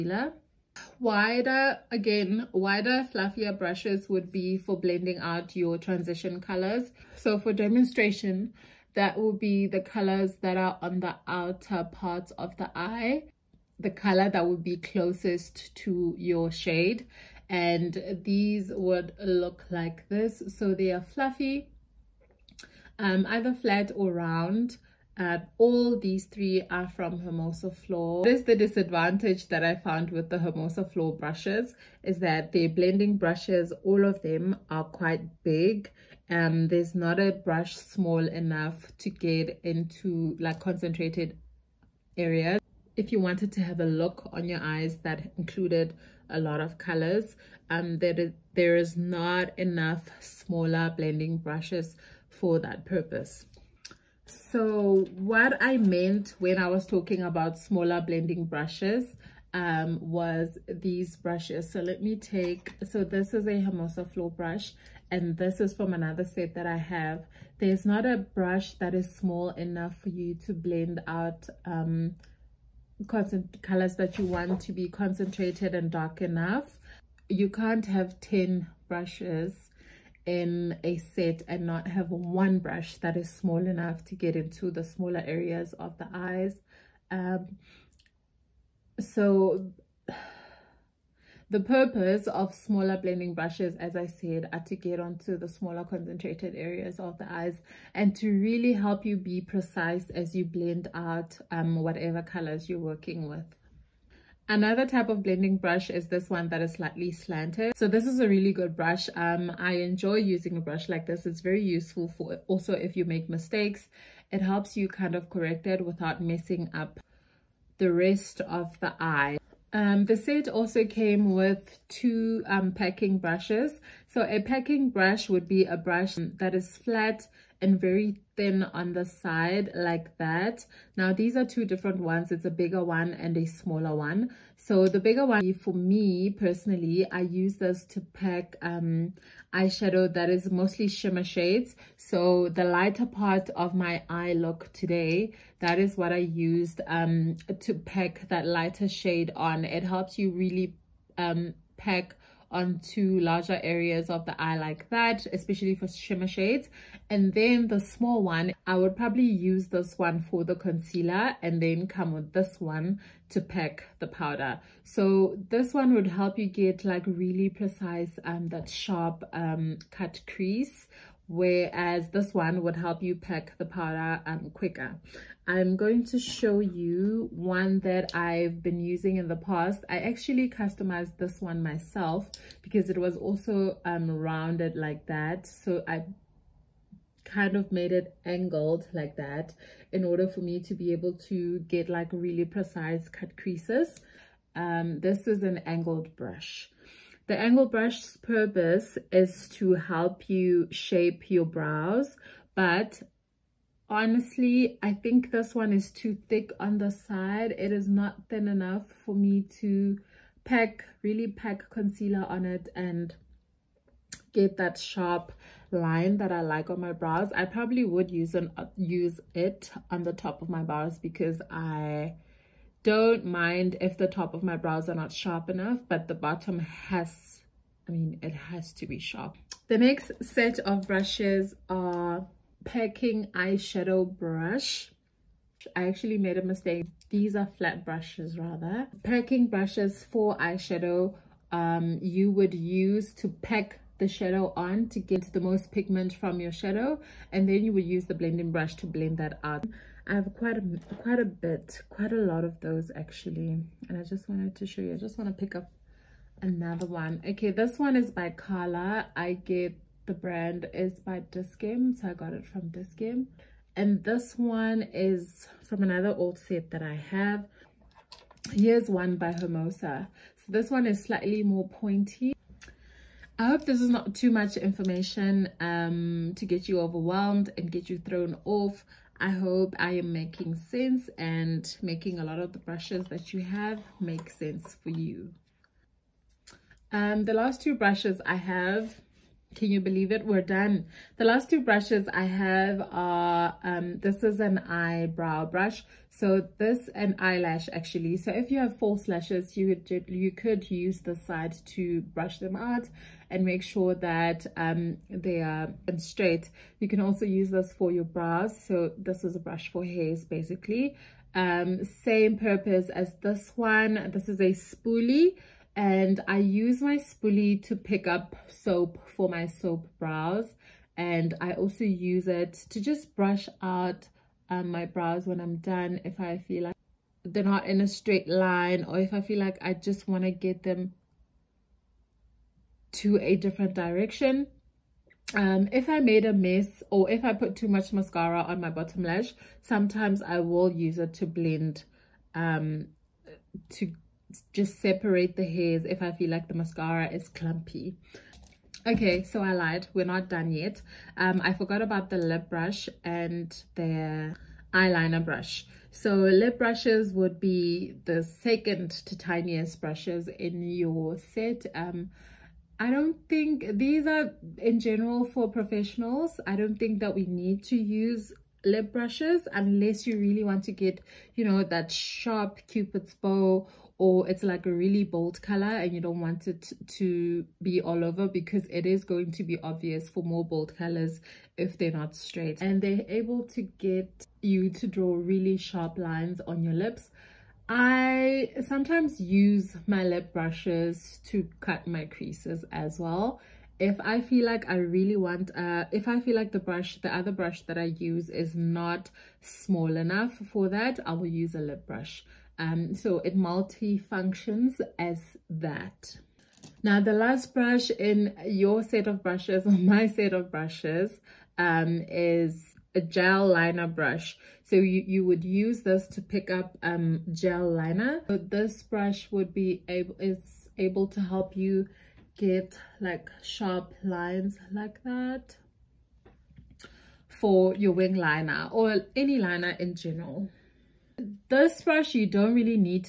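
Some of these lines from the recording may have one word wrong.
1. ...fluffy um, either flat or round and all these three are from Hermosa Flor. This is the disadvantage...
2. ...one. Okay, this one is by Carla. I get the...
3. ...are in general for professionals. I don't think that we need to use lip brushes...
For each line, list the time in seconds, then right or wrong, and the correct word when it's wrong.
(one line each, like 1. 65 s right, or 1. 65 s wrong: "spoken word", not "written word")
1. 21 s right
2. 256 s right
3. 364 s right.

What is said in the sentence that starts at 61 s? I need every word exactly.
So let me take, so this is a Hermosa Flor brush and this is from another set that I have.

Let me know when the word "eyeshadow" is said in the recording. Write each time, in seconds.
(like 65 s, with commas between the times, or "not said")
139 s, 233 s, 240 s.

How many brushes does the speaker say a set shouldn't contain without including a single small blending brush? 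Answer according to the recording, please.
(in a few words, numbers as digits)
10.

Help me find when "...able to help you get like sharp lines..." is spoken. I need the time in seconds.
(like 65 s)
420 s.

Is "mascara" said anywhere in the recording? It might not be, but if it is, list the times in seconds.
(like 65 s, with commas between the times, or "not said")
337 s, 346 s.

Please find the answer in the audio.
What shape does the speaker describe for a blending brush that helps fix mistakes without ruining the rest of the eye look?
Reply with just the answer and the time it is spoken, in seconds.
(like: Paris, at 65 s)
Slightly slanted, at 106 s.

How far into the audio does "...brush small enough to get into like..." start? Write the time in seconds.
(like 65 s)
37 s.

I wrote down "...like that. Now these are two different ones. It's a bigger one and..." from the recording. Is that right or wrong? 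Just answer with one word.
right.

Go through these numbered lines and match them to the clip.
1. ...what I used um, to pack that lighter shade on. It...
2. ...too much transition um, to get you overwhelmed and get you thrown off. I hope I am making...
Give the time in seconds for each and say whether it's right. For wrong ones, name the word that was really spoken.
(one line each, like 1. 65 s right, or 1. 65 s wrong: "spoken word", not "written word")
1. 145 s right
2. 274 s wrong: "information", not "transition".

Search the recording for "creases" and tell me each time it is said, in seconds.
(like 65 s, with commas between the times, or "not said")
170 s, 193 s, 392 s.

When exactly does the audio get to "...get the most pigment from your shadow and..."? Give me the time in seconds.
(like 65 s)
244 s.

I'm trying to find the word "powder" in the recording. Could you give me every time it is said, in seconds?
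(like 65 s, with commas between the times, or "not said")
164 s, 173 s.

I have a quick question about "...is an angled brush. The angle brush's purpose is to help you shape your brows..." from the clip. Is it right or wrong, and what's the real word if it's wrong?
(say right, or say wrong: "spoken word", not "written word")
right.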